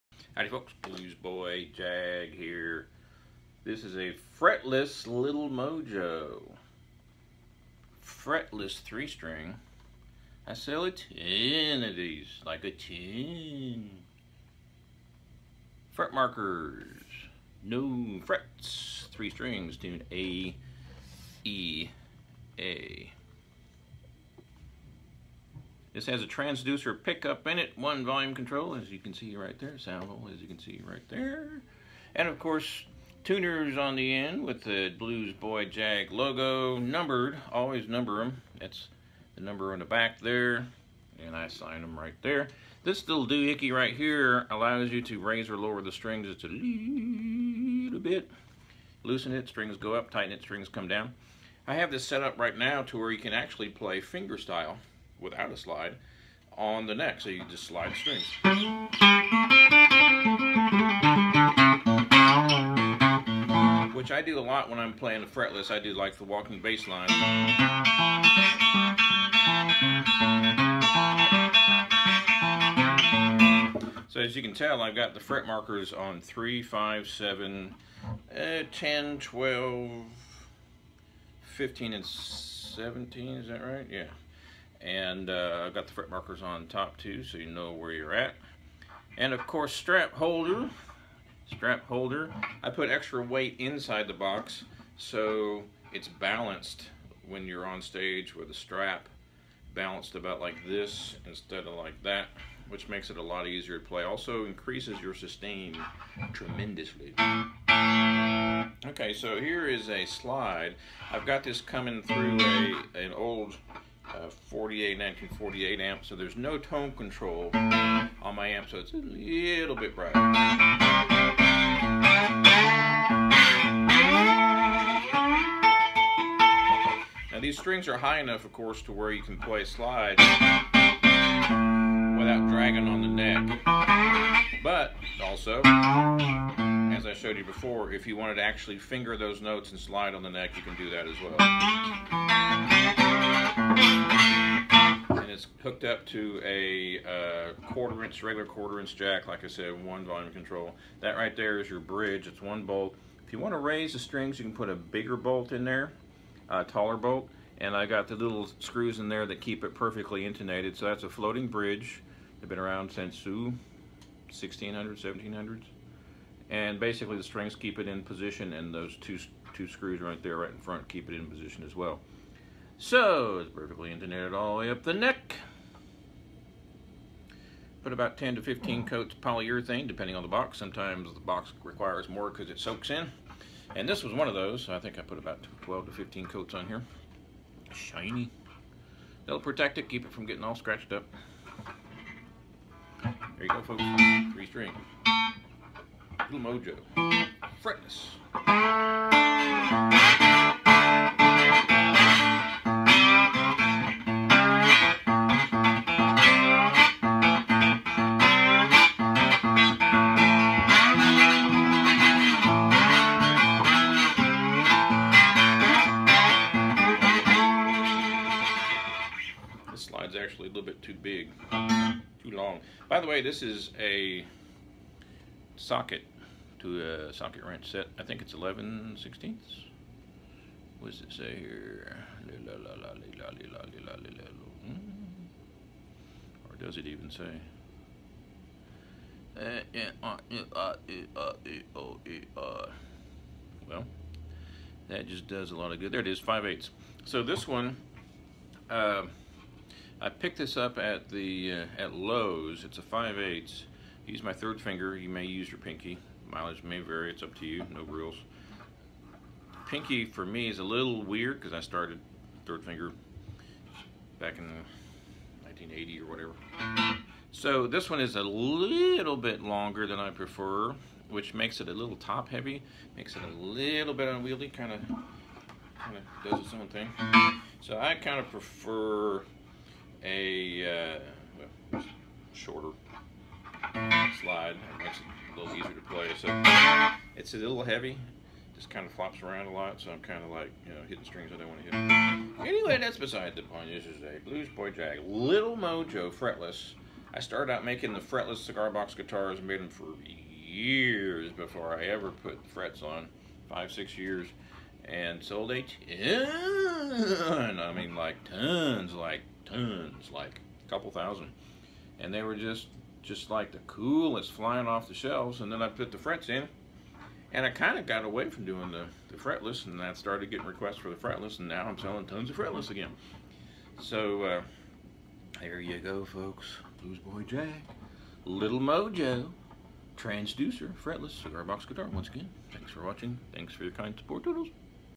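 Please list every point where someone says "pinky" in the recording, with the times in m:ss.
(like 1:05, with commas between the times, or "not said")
4:15, 4:19.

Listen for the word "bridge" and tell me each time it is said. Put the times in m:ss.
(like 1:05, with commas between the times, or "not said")
2:31, 2:41.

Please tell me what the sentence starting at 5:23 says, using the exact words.
So uh, there you go, folks.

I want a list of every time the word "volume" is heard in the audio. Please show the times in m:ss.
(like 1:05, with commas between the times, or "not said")
0:28, 2:30.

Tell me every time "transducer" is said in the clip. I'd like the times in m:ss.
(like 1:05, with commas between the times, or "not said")
0:26, 5:29.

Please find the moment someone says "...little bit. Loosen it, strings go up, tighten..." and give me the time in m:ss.
0:46.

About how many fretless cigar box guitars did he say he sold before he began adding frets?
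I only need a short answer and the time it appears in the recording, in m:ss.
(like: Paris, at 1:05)
a couple thousand, at 5:10.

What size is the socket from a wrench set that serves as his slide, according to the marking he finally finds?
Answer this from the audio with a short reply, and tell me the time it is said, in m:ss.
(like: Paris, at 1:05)
5/8, at 4:06.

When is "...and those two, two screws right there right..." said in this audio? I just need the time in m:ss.
2:48.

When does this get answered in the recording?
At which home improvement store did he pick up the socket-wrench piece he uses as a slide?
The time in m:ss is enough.
4:11.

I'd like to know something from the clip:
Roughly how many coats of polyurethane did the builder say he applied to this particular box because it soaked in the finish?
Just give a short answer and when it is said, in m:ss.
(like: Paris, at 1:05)
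12 to 15, at 3:05.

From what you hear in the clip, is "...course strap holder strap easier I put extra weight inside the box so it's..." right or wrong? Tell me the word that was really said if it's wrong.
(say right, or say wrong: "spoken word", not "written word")
wrong: "holder", not "easier".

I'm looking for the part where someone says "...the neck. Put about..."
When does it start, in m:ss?
2:54.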